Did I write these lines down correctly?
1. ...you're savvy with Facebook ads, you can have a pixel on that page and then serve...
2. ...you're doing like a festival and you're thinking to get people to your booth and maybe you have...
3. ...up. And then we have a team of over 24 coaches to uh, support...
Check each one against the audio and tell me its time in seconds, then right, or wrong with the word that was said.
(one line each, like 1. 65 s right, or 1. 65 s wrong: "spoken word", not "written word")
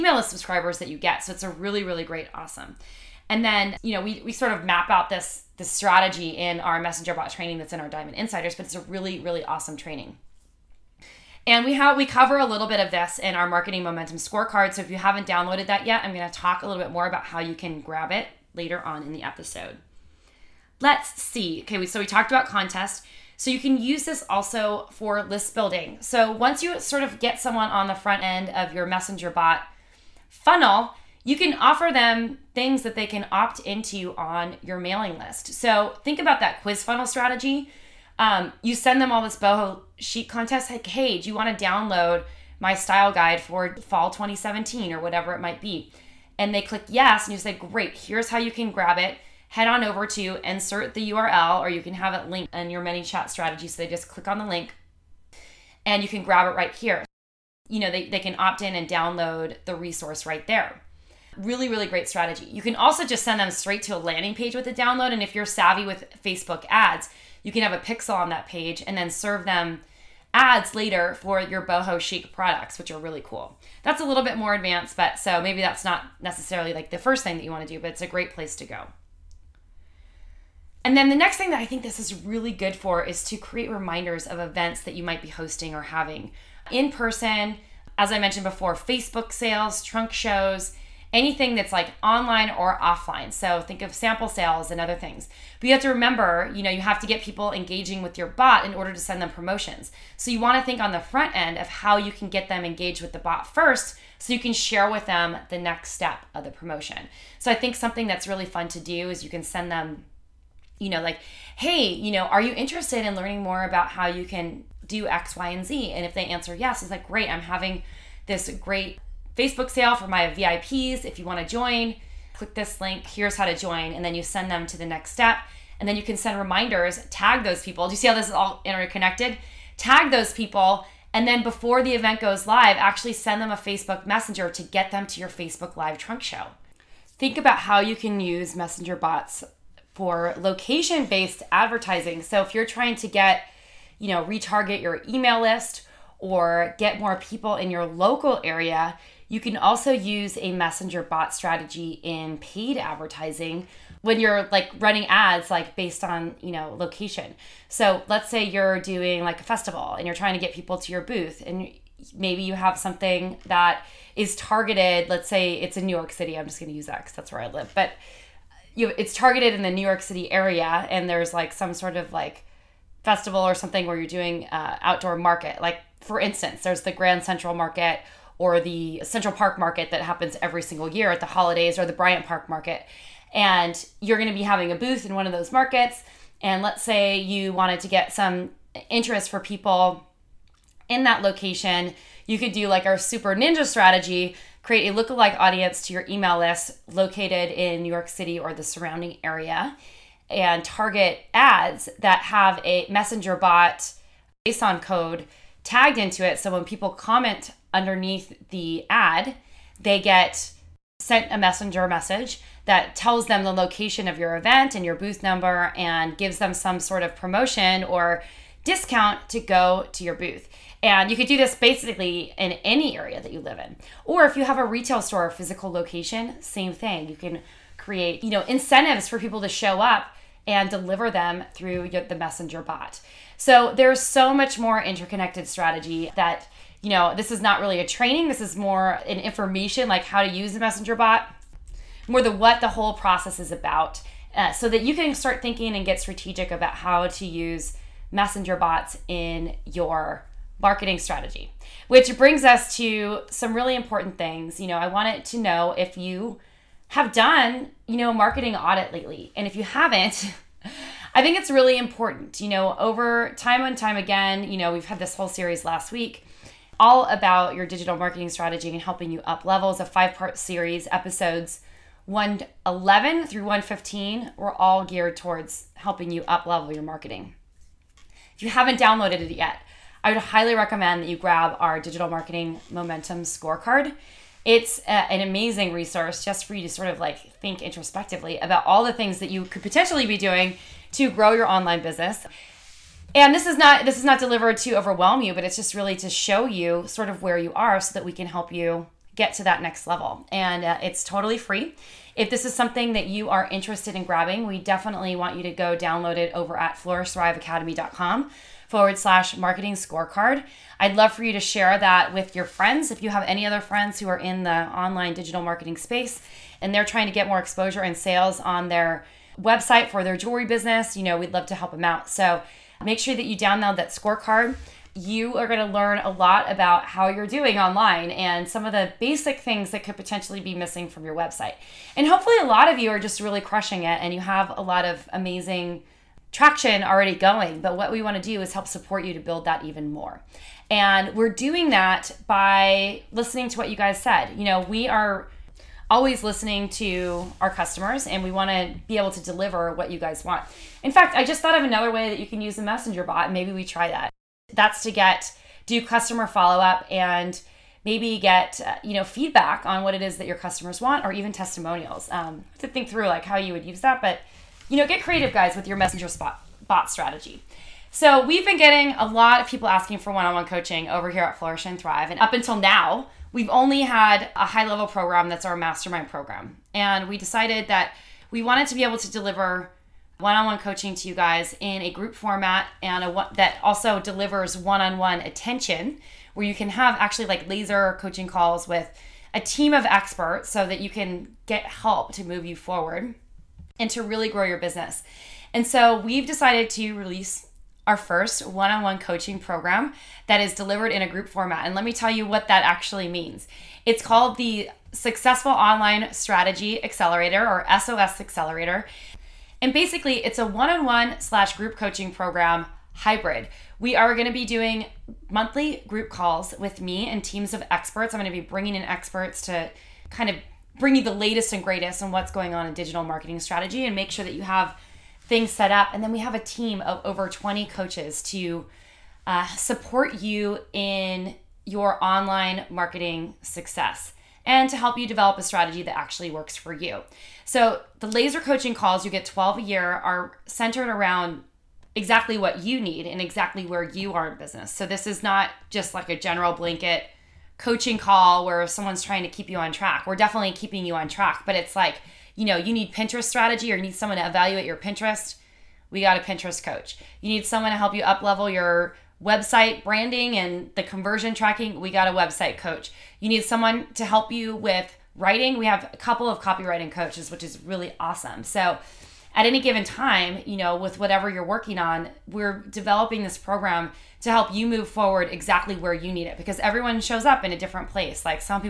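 1. 65 s right
2. 158 s wrong: "trying", not "thinking"
3. 425 s wrong: "20", not "24".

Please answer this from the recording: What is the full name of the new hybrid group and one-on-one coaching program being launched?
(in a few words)
Successful Online Strategy Accelerator.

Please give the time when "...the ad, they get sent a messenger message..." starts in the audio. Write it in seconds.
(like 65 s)
208 s.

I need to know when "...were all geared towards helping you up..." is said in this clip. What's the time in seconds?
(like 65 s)
274 s.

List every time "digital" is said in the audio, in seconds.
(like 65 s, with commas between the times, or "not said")
267 s, 281 s, 315 s, 422 s.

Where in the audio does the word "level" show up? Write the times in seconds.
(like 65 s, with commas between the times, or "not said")
269 s, 276 s, 299 s, 374 s, 458 s.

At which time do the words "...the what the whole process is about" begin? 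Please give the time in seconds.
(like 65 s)
242 s.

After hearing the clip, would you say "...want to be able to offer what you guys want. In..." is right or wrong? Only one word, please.
wrong.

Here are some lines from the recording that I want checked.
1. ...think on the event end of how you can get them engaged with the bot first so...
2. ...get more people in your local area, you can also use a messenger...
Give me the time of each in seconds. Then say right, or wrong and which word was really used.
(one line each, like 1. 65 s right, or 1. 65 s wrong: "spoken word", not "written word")
1. 100 s wrong: "front", not "event"
2. 146 s right.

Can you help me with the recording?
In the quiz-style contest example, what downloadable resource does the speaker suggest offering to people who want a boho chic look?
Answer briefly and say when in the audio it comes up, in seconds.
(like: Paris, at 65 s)
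style guide for fall 2017, at 42 s.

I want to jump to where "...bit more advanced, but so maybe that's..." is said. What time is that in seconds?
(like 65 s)
74 s.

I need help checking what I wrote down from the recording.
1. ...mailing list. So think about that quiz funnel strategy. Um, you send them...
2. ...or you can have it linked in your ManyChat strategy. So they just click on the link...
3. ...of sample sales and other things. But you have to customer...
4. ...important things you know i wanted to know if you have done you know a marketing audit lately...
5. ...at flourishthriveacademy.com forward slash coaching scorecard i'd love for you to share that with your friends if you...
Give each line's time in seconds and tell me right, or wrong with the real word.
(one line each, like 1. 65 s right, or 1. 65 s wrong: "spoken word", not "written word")
1. 34 s right
2. 51 s right
3. 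93 s wrong: "remember", not "customer"
4. 253 s right
5. 306 s wrong: "marketing", not "coaching".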